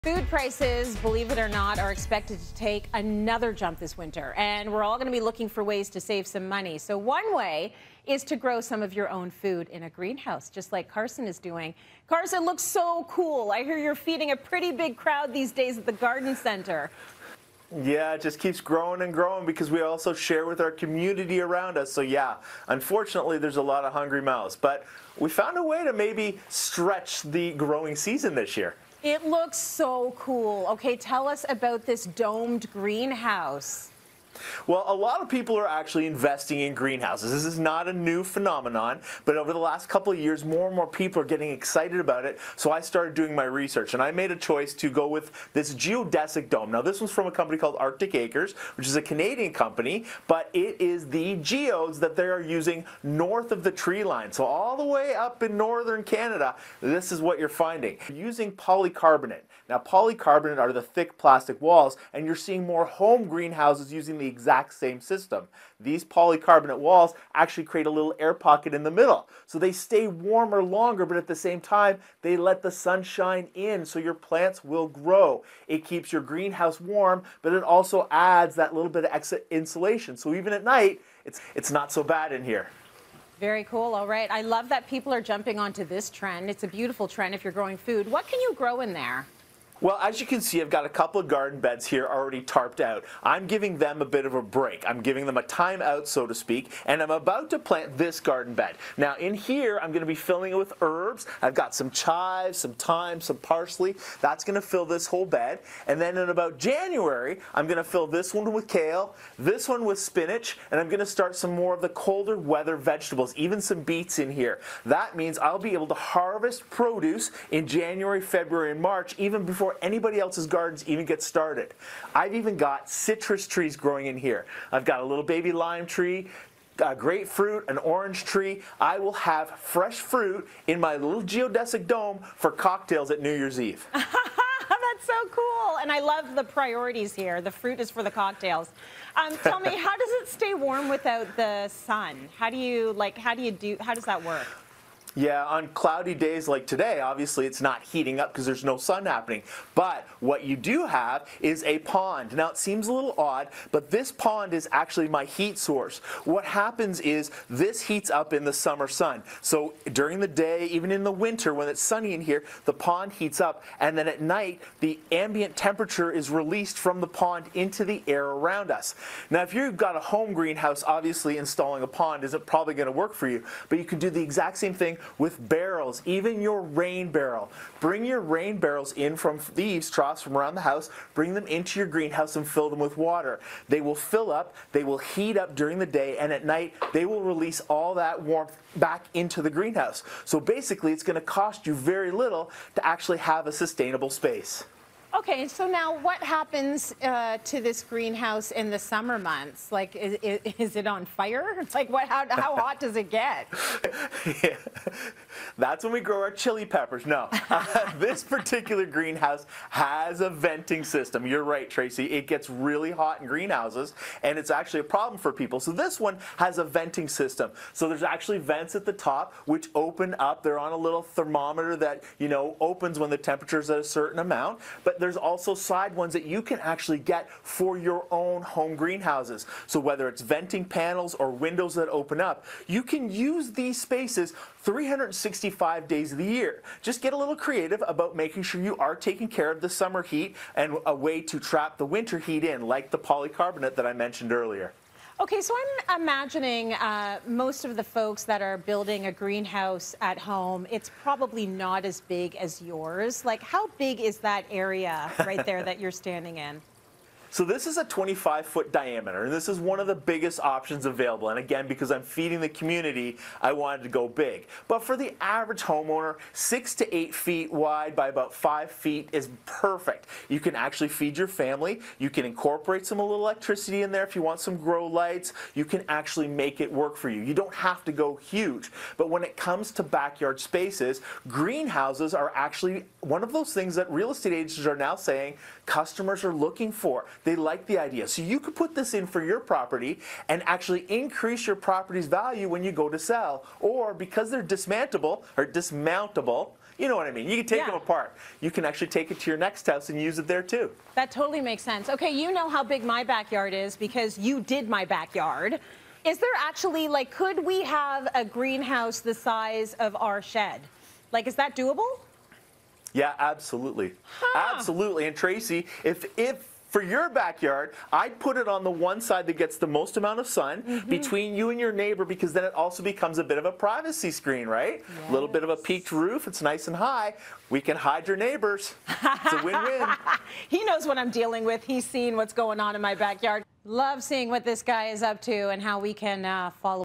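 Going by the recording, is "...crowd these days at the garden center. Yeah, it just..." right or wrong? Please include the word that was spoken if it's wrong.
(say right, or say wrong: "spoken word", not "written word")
right.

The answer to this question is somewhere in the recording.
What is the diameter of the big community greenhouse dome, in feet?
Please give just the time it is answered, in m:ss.
4:17.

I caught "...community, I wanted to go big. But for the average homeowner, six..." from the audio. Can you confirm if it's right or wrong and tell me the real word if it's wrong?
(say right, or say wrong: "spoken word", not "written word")
right.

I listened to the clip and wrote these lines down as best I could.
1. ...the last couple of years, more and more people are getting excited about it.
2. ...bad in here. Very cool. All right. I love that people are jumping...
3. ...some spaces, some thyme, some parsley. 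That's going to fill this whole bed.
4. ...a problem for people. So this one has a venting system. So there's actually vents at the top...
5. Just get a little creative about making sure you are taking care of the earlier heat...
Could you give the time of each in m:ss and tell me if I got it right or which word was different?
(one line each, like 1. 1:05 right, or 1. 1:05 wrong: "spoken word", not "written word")
1. 0:39 right
2. 1:22 right
3. 1:41 wrong: "chives", not "spaces"
4. 3:34 right
5. 3:56 wrong: "summer", not "earlier".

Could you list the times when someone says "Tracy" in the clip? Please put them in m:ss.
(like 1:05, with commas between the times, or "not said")
3:31, 5:15.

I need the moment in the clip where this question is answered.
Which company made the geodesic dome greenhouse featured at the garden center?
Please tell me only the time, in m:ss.
0:47.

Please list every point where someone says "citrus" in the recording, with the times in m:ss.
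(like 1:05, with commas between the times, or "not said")
2:02.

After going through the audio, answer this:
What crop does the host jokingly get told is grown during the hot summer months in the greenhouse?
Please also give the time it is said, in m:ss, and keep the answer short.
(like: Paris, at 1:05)
Chili peppers, at 3:26.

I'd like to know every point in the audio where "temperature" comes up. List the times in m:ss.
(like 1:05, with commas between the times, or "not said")
2:45, 3:43.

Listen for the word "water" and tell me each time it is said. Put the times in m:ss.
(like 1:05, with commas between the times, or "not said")
3:02.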